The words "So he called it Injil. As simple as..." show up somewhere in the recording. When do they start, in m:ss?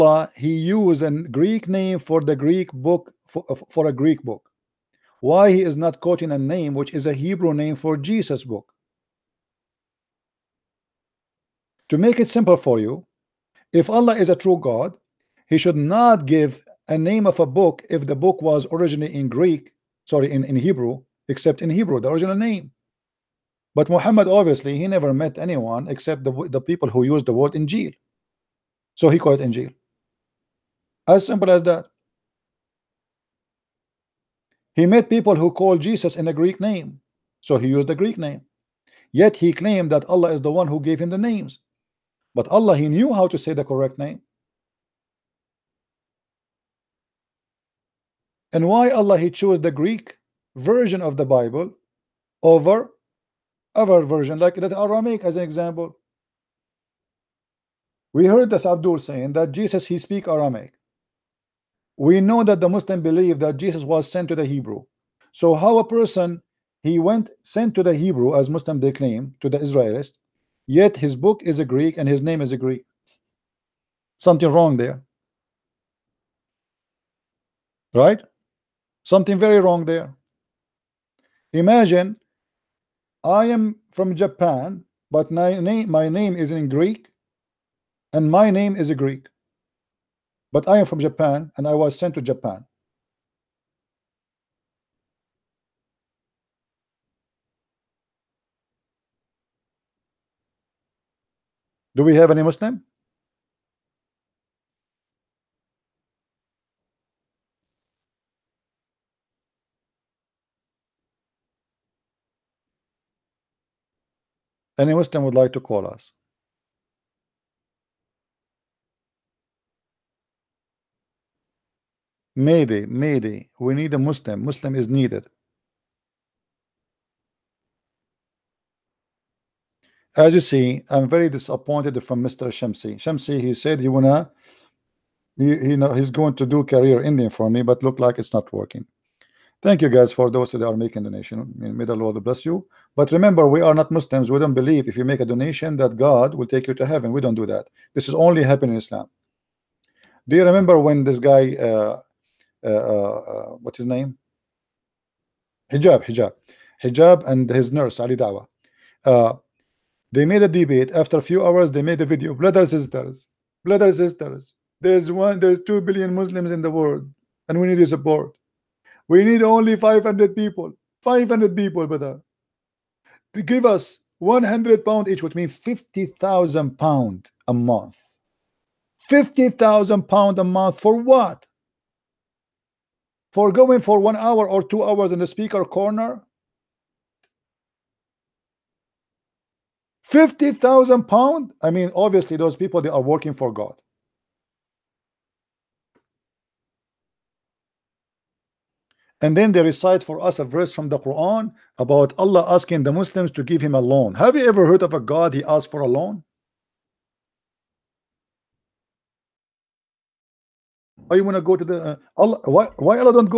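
0:28.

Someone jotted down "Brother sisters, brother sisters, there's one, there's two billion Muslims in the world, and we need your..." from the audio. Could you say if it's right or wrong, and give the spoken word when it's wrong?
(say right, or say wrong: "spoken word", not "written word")
right.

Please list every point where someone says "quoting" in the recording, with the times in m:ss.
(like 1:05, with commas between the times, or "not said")
0:06.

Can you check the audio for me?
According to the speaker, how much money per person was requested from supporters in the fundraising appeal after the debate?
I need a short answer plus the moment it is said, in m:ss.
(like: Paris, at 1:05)
100 pounds, at 2:54.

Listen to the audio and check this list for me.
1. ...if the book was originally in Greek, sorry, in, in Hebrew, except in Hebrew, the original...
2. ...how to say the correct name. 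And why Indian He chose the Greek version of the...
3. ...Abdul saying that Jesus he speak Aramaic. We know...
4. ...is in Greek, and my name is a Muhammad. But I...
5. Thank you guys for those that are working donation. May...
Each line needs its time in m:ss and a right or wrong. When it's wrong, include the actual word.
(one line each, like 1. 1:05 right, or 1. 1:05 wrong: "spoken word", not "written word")
1. 0:17 right
2. 0:43 wrong: "Allah", not "Indian"
3. 0:58 right
4. 1:26 wrong: "Greek", not "Muhammad"
5. 2:19 wrong: "making", not "working".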